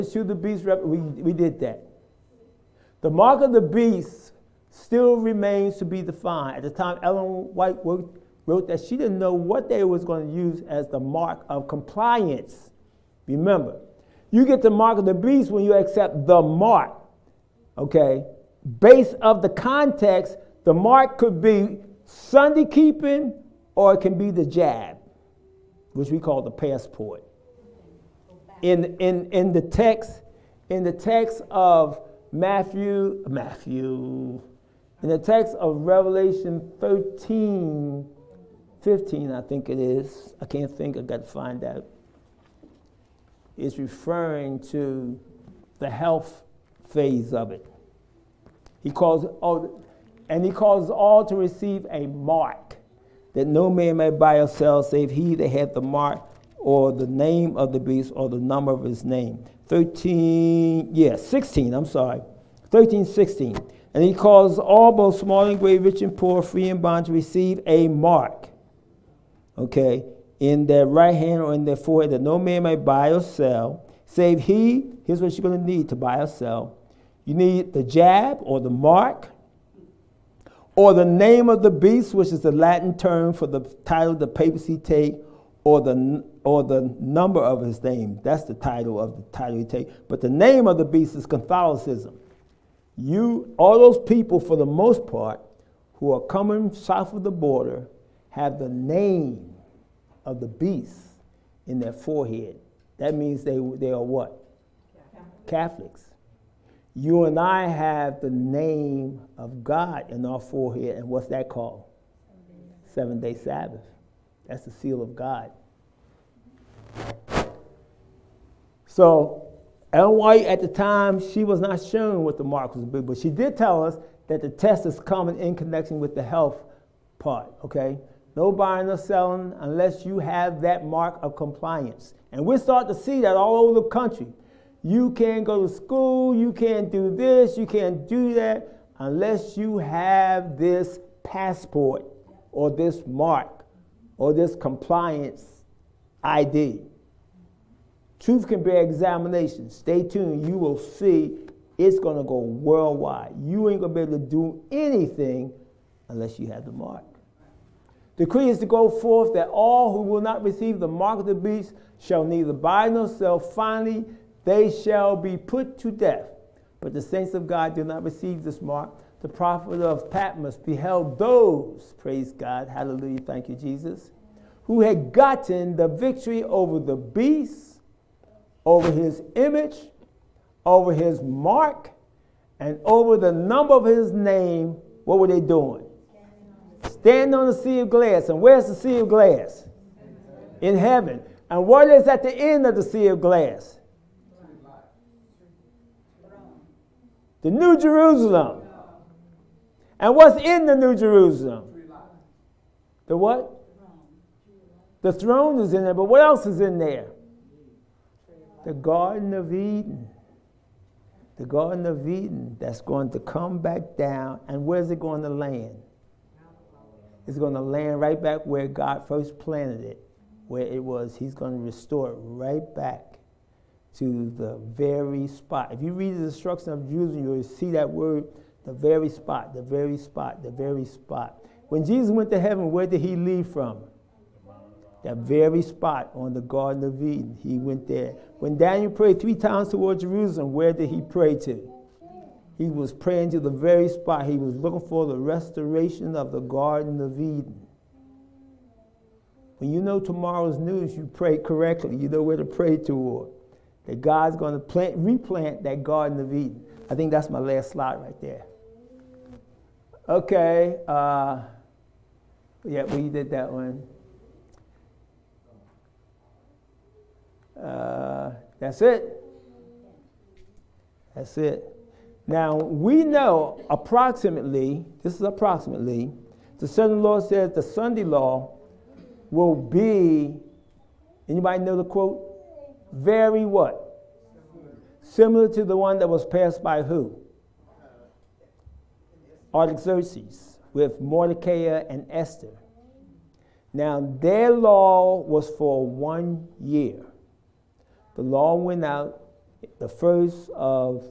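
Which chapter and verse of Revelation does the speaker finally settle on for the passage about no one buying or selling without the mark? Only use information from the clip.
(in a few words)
13:16.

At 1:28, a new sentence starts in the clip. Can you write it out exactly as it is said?
That's the title of the title he take.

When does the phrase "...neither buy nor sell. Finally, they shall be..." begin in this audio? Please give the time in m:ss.
2:42.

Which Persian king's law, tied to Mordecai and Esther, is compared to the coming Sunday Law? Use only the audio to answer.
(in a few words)
Artaxerxes.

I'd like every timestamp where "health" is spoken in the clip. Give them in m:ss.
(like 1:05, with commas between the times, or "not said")
0:45, 2:06.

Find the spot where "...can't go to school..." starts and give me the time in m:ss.
2:15.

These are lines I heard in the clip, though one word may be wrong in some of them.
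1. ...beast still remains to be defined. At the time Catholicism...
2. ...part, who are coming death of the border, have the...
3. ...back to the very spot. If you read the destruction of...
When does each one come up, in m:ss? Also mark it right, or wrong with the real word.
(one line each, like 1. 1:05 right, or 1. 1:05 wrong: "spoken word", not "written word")
1. 0:03 wrong: "Ellen", not "Catholicism"
2. 1:35 wrong: "south", not "death"
3. 3:42 right.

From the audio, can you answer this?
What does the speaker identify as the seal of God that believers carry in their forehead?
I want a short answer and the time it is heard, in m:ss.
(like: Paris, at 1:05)
Seven day Sabbath, at 1:52.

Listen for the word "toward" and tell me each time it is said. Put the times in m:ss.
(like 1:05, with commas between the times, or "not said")
3:59, 4:12.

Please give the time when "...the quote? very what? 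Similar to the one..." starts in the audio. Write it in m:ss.
4:41.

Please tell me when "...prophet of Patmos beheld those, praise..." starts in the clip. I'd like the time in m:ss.
2:49.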